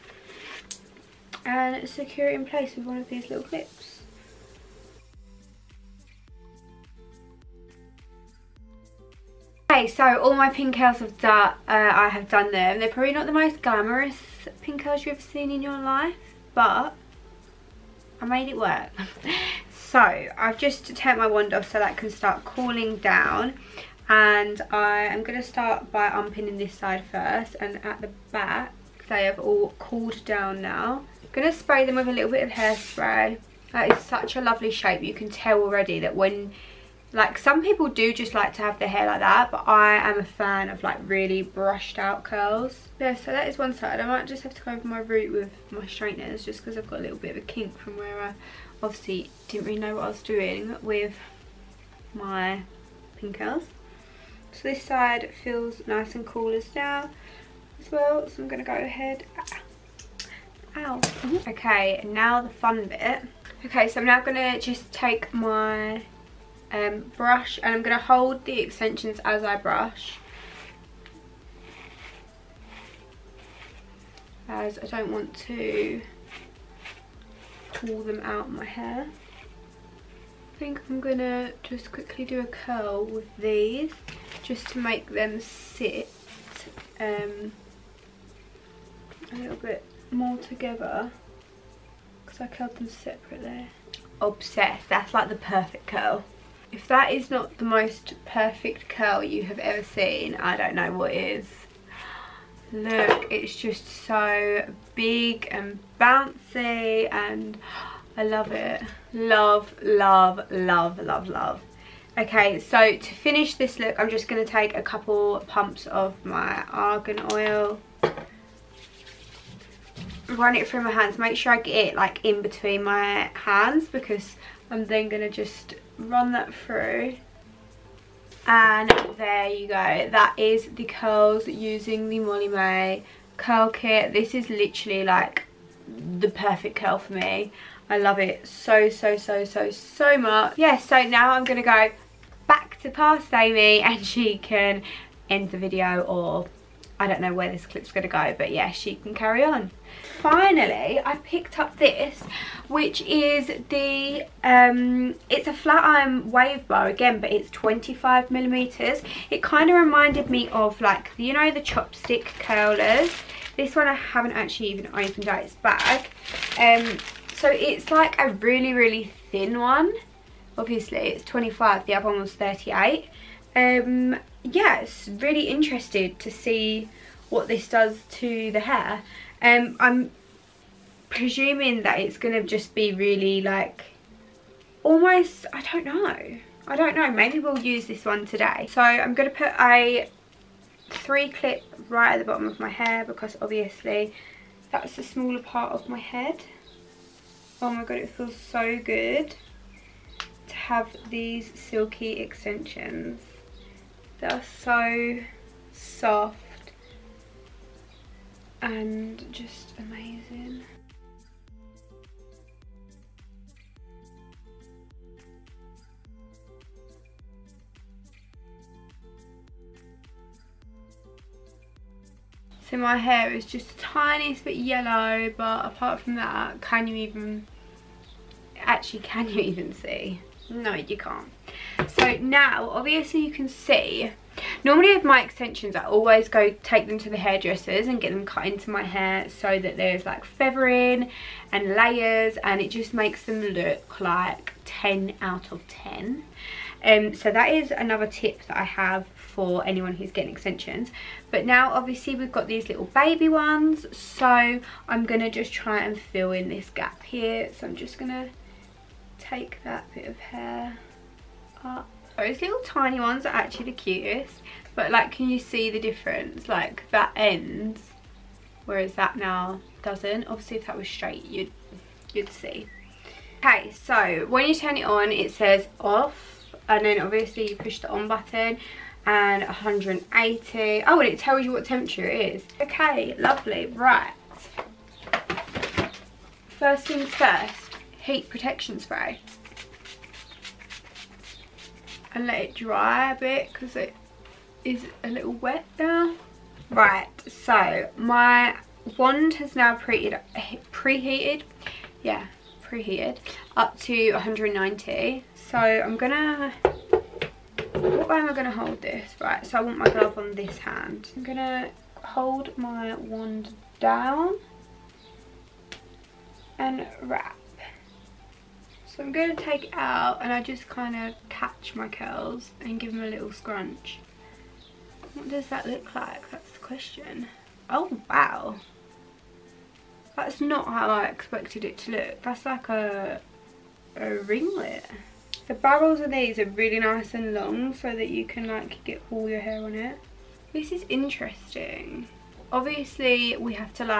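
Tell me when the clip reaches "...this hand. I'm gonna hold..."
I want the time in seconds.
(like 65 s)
310 s.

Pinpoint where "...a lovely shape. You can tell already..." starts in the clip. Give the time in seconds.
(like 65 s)
34 s.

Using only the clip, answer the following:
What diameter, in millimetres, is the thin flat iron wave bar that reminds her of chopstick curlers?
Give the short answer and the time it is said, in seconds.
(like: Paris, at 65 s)
25 millimeters, at 157 s.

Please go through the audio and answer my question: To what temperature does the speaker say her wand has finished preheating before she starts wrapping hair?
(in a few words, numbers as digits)
190.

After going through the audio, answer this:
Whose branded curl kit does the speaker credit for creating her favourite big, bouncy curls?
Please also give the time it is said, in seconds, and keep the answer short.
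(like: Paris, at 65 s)
Molly-Mae, at 132 s.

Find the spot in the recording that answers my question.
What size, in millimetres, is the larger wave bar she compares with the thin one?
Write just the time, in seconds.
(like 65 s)
172 s.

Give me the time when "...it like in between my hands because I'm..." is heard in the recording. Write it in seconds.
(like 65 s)
121 s.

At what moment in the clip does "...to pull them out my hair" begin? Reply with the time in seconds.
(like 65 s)
75 s.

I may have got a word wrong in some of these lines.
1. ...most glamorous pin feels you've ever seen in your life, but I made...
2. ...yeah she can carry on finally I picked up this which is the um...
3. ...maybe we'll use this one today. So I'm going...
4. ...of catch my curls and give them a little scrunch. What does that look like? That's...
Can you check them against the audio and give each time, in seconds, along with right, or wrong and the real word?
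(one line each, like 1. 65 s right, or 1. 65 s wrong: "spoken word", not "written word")
1. 13 s wrong: "curls", not "feels"
2. 148 s right
3. 187 s right
4. 320 s right.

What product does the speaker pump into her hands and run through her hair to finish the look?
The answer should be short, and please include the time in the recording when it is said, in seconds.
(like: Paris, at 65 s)
argan oil, at 116 s.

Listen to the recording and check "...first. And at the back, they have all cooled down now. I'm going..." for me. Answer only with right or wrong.
right.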